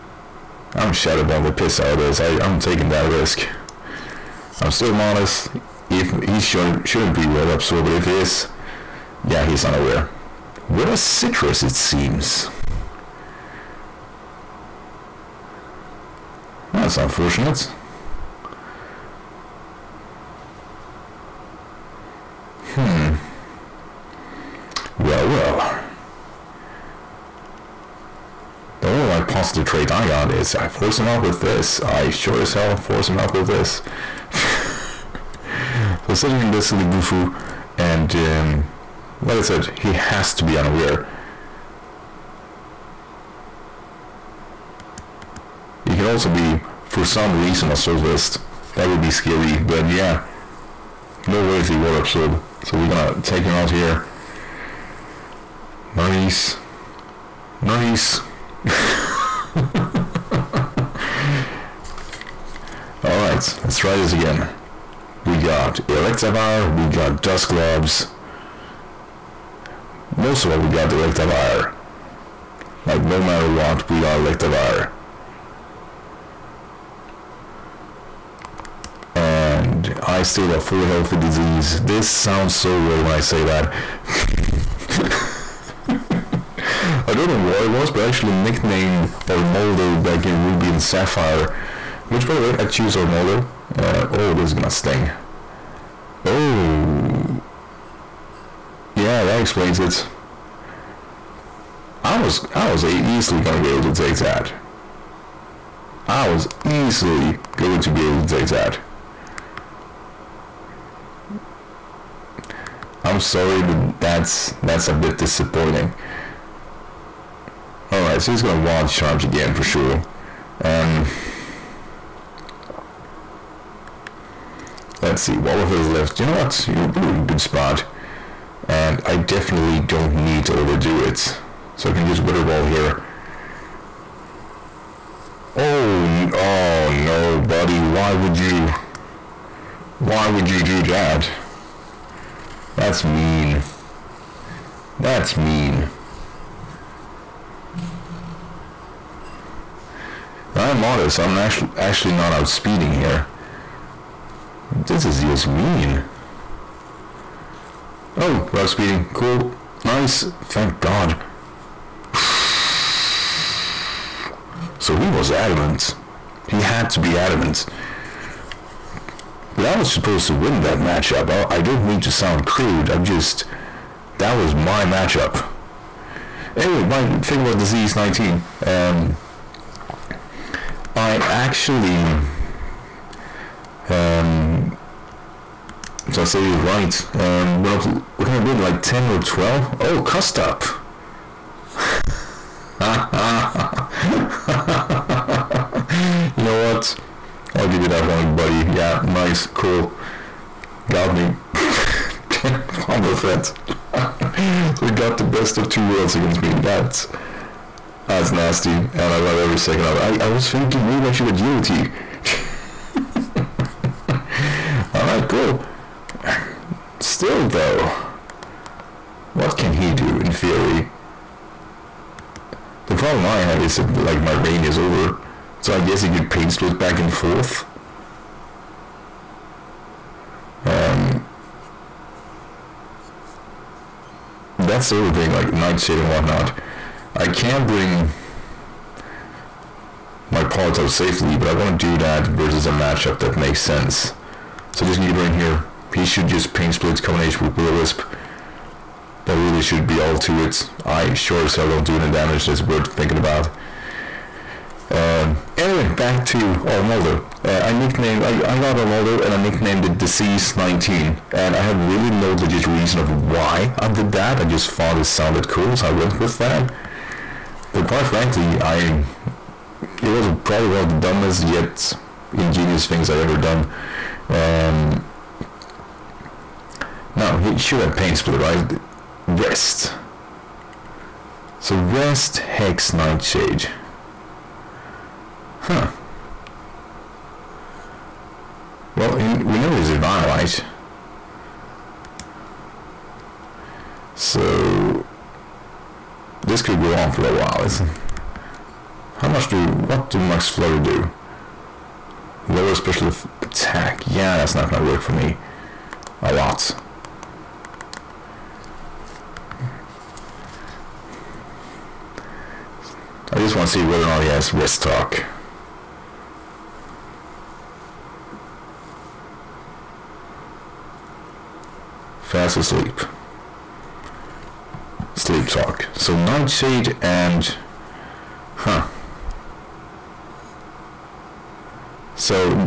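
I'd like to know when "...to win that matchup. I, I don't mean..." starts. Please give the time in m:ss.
2:50.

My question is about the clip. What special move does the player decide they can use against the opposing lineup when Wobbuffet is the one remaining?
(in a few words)
Weather Ball.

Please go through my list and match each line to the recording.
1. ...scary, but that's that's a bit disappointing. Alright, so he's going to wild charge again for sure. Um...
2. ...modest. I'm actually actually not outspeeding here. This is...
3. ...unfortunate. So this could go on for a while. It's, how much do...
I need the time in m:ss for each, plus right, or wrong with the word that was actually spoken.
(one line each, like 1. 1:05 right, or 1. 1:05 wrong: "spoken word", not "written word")
1. 1:53 wrong: "sorry", not "scary"
2. 2:30 right
3. 4:49 wrong: "violite", not "unfortunate".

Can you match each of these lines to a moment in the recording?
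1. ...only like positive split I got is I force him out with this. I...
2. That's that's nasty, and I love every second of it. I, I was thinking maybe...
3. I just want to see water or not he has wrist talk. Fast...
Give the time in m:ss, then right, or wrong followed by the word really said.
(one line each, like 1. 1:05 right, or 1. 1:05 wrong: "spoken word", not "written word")
1. 0:28 wrong: "trait", not "split"
2. 3:26 right
3. 5:13 wrong: "whether", not "water".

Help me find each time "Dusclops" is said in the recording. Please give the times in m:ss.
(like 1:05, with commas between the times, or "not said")
1:07.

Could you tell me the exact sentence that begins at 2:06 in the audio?
You know, we're in a good spot.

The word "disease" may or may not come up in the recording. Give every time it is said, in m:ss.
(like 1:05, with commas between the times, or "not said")
1:21, 2:57, 4:19.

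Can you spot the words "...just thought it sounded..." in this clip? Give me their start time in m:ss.
4:24.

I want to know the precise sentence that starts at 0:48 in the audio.
That would be scary, but yeah.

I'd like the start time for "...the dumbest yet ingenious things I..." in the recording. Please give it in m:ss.
4:30.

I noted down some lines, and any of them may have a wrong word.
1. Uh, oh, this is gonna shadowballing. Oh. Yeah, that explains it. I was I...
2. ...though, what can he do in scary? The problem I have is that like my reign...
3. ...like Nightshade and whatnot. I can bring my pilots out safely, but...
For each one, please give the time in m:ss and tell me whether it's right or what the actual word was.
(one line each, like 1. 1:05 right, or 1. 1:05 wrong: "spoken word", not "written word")
1. 1:33 wrong: "sting", not "shadowballing"
2. 3:37 wrong: "theory", not "scary"
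3. 3:55 right.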